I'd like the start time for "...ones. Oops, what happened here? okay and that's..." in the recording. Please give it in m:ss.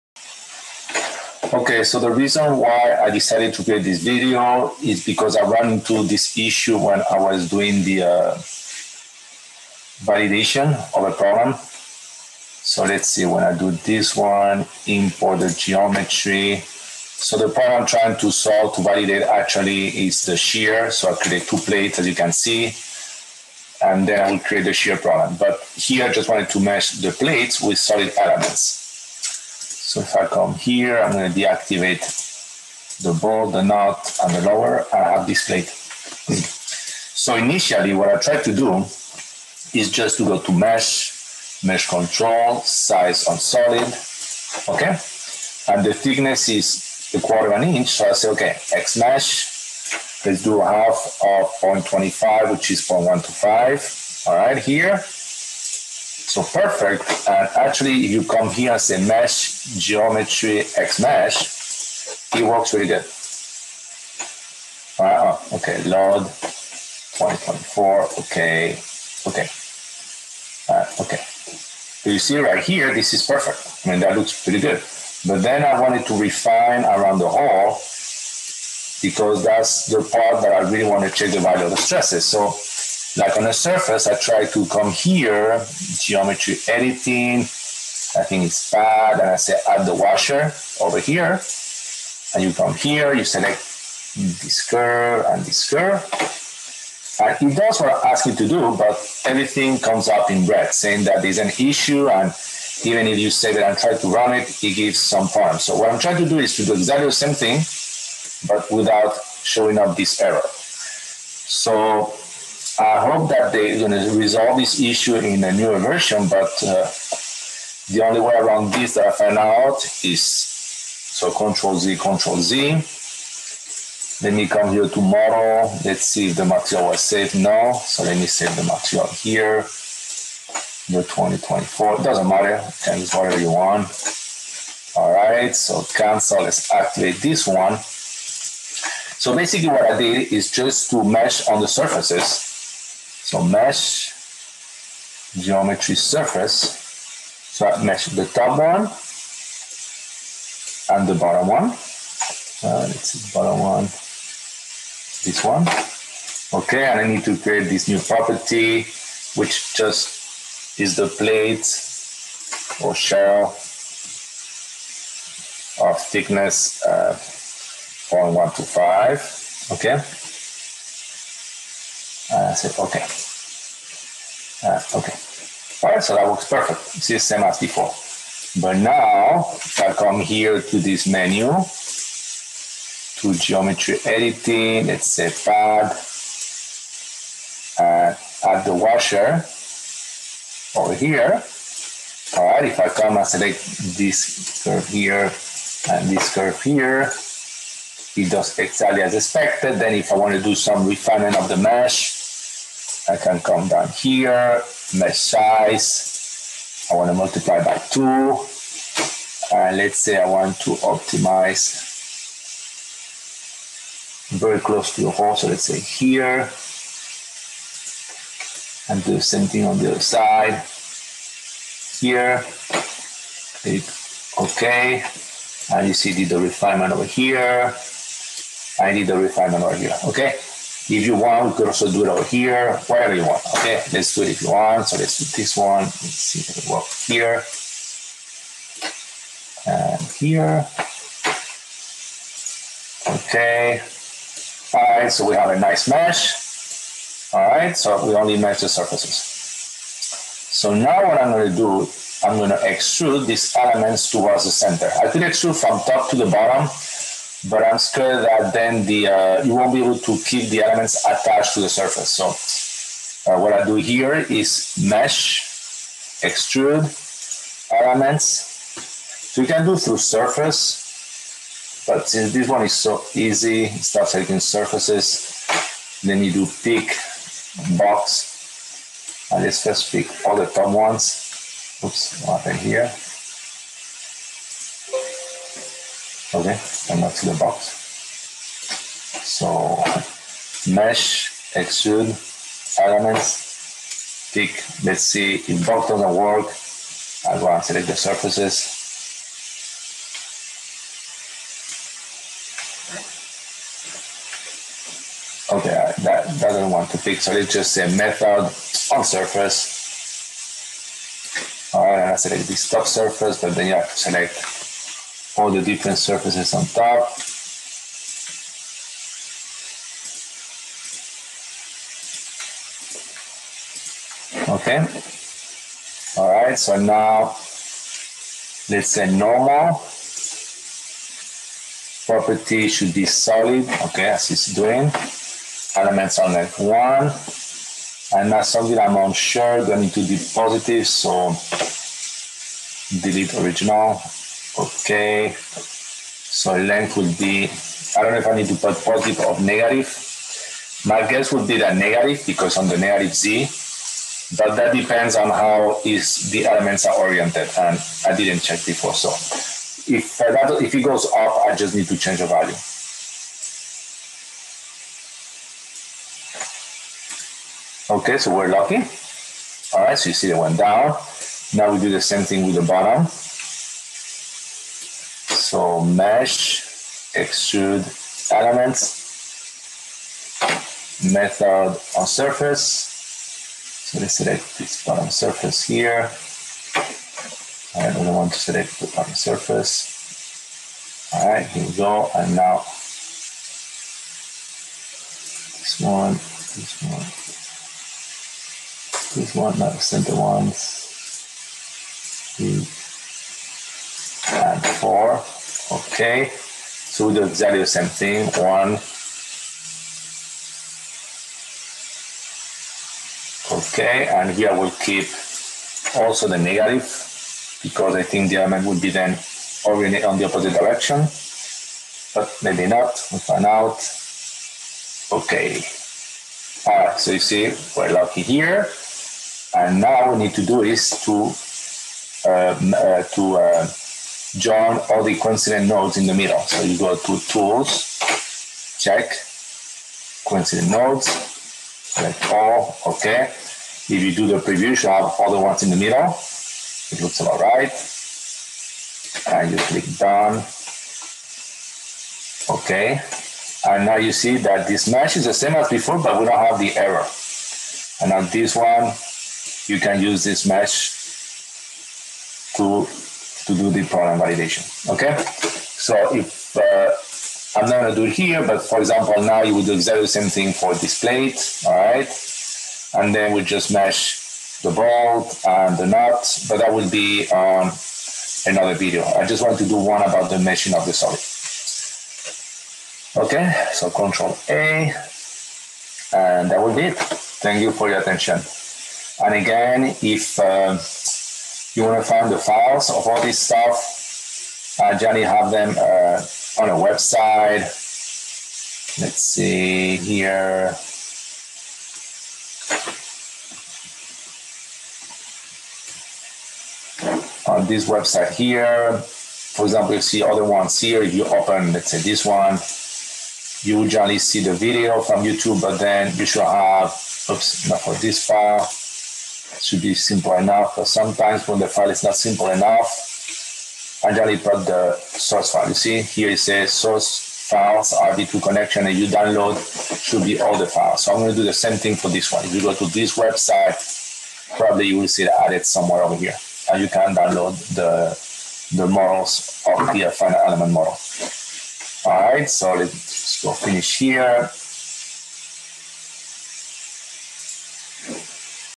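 4:40.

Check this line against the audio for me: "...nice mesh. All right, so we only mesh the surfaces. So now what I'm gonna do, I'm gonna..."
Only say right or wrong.
right.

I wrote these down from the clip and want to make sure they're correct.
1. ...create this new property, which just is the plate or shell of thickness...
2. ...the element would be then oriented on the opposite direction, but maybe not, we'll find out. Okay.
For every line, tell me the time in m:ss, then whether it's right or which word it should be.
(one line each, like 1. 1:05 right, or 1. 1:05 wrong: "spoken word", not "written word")
1. 2:37 right
2. 6:58 right.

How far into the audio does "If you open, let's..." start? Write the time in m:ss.
8:31.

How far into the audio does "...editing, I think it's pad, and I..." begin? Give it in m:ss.
1:26.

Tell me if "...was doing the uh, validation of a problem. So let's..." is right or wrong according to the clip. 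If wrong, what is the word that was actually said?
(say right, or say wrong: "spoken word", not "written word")
right.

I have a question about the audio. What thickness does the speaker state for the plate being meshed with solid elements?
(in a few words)
a quarter of an inch.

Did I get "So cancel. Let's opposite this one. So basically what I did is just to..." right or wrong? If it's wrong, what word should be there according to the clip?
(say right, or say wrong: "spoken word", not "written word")
wrong: "activate", not "opposite".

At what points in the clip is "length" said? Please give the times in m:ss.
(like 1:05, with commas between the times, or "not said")
5:36, 5:46.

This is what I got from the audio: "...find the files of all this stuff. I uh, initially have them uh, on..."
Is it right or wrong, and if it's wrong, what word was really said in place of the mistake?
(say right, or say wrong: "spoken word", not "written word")
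wrong: "generally", not "initially".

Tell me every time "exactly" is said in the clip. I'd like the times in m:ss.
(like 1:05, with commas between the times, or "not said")
1:46, 3:18, 6:47, 7:49.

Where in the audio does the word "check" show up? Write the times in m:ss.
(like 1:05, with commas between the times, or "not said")
1:21, 5:58, 7:18.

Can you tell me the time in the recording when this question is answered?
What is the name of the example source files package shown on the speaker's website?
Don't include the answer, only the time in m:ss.
8:47.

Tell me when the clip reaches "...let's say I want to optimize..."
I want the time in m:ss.
3:29.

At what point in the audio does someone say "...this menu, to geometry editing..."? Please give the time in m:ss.
3:00.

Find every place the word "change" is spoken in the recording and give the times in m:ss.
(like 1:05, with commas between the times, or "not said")
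6:01.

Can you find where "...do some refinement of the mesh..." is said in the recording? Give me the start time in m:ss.
3:20.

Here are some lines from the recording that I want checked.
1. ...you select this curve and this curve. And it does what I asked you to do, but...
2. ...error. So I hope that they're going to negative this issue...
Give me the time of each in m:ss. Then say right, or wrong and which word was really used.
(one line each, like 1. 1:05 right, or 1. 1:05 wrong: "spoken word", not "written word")
1. 1:33 right
2. 1:50 wrong: "resolve", not "negative".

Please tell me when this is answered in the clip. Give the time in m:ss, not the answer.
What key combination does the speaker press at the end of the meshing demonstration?
8:03.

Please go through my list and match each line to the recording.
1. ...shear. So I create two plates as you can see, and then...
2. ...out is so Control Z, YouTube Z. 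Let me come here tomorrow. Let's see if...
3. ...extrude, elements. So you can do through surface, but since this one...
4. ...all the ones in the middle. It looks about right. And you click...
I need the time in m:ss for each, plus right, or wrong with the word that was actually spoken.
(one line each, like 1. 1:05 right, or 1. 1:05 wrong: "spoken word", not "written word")
1. 0:20 right
2. 1:59 wrong: "Control", not "YouTube"
3. 4:26 right
4. 7:25 right.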